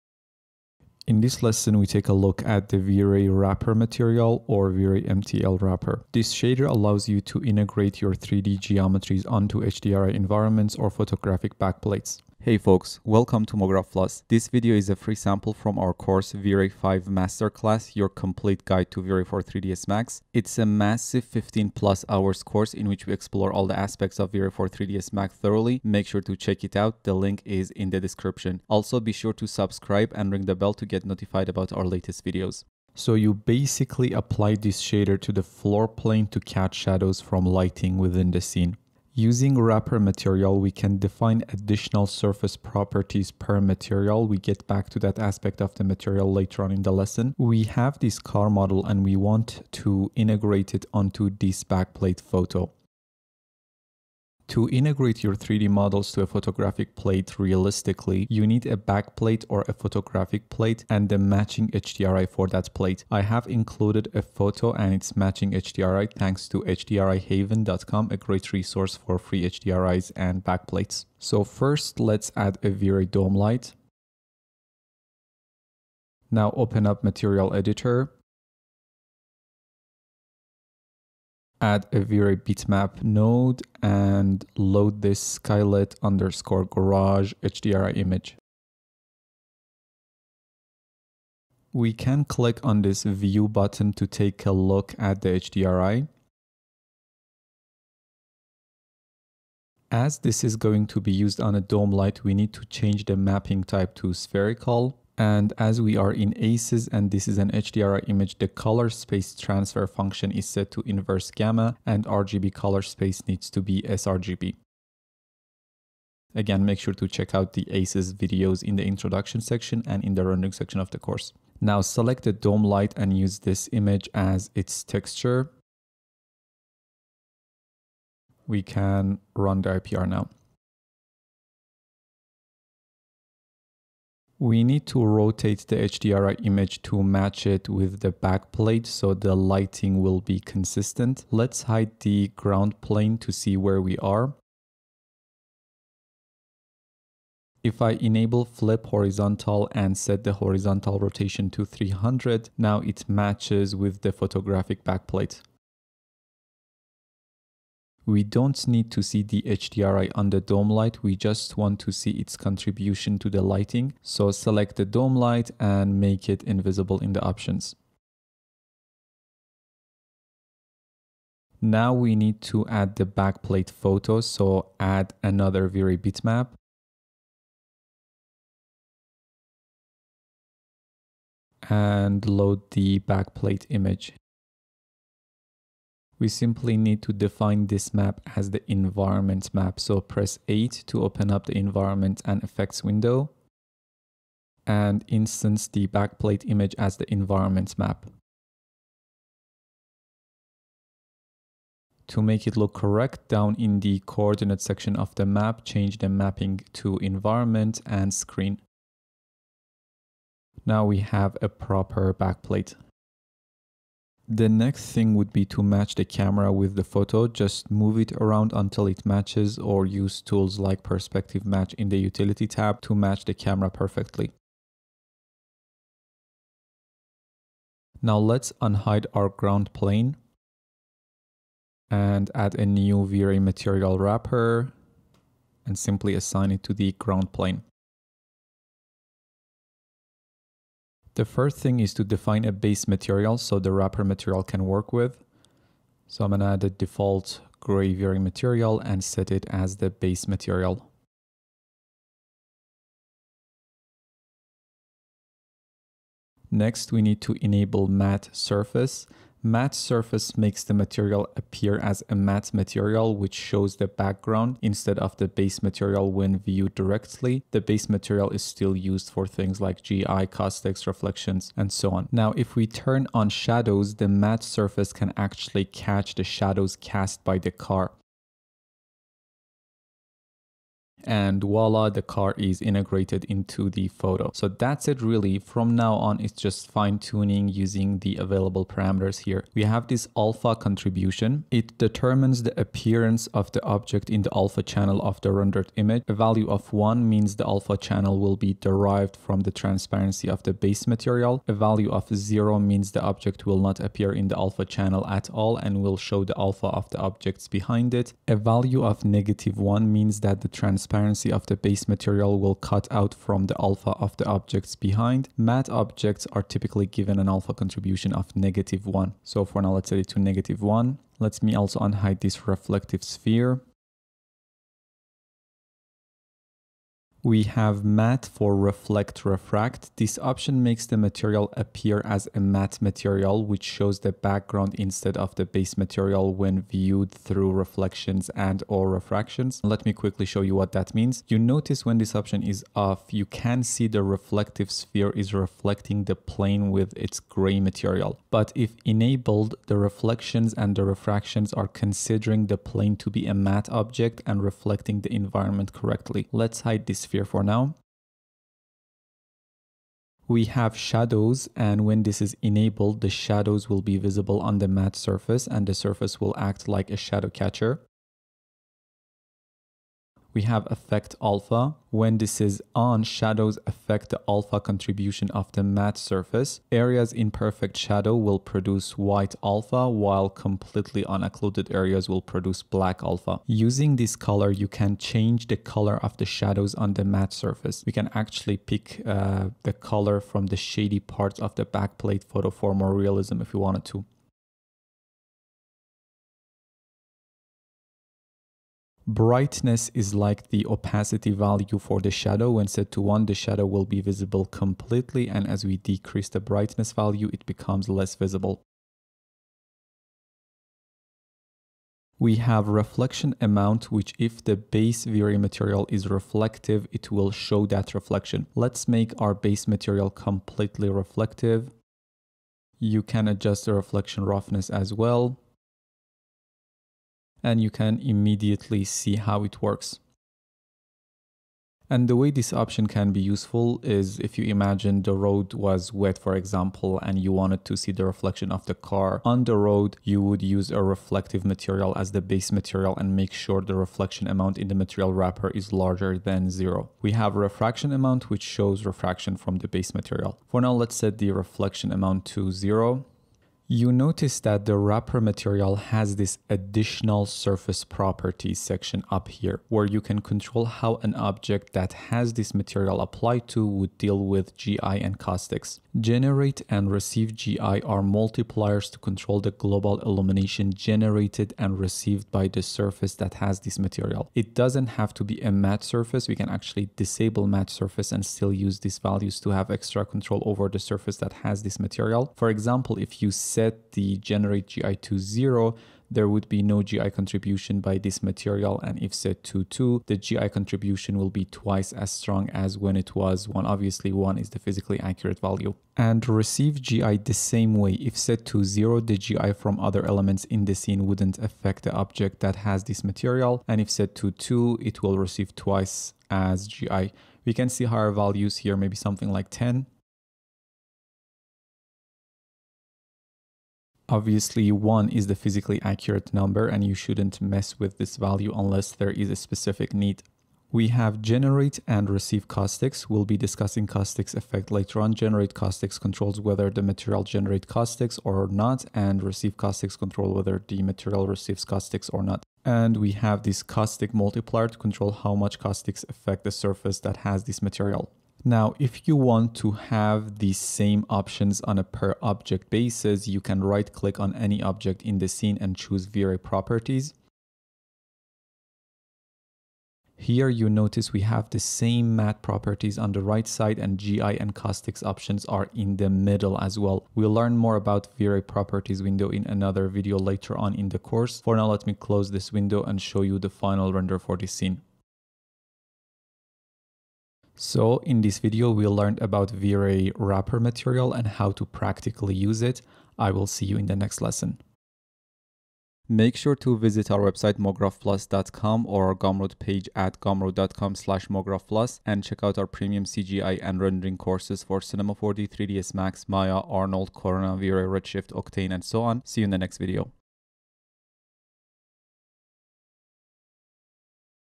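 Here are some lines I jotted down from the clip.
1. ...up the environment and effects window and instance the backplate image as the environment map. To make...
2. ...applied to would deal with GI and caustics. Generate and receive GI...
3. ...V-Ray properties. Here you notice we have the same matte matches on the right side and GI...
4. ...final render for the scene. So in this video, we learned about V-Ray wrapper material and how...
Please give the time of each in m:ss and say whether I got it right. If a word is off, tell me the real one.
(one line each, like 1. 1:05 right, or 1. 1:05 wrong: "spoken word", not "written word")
1. 3:11 right
2. 7:42 right
3. 9:06 wrong: "properties", not "matches"
4. 9:23 right.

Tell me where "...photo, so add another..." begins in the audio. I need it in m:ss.
2:53.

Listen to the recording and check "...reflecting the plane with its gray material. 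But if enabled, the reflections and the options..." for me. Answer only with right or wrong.
wrong.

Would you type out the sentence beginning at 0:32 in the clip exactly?
So you basically apply this shader to the floor plane to catch shadows from lighting within the scene.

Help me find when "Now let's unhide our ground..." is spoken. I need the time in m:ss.
3:48.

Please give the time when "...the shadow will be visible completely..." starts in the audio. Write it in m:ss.
6:43.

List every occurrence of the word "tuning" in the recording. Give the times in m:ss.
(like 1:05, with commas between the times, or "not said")
4:46.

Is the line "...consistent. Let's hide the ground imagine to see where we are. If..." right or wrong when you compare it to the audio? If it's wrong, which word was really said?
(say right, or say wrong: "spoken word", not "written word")
wrong: "plane", not "imagine".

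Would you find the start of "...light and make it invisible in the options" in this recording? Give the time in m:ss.
2:45.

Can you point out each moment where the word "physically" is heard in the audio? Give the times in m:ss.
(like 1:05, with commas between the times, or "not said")
8:14, 8:35.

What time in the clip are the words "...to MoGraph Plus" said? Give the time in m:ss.
0:13.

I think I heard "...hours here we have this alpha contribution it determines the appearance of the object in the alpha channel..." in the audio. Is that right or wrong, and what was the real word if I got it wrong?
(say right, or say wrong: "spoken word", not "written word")
wrong: "parameters", not "hours".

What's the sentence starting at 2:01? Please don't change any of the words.
Now select the dome light and use this image as its texture.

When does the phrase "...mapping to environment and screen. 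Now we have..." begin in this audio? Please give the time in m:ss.
3:26.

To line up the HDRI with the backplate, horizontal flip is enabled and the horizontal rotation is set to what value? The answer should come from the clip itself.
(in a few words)
300.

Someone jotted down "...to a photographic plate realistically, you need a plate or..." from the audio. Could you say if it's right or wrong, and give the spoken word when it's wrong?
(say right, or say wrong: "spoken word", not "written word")
wrong: "backplate", not "plate".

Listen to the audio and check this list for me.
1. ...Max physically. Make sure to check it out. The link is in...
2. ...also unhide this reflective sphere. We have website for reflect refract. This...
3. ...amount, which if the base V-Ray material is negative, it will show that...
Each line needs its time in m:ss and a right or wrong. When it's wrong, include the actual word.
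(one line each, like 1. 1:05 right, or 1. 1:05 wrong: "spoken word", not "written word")
1. 0:25 wrong: "thoroughly", not "physically"
2. 5:21 wrong: "matte", not "website"
3. 6:53 wrong: "reflective", not "negative".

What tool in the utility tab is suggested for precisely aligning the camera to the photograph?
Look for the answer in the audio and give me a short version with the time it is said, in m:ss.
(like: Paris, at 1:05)
perspective match, at 3:40.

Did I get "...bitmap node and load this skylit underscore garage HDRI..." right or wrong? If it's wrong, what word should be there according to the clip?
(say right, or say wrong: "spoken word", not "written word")
right.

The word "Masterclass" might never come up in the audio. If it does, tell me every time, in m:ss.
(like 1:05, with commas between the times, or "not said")
0:17.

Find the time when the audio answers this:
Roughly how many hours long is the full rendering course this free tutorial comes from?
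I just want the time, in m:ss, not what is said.
0:21.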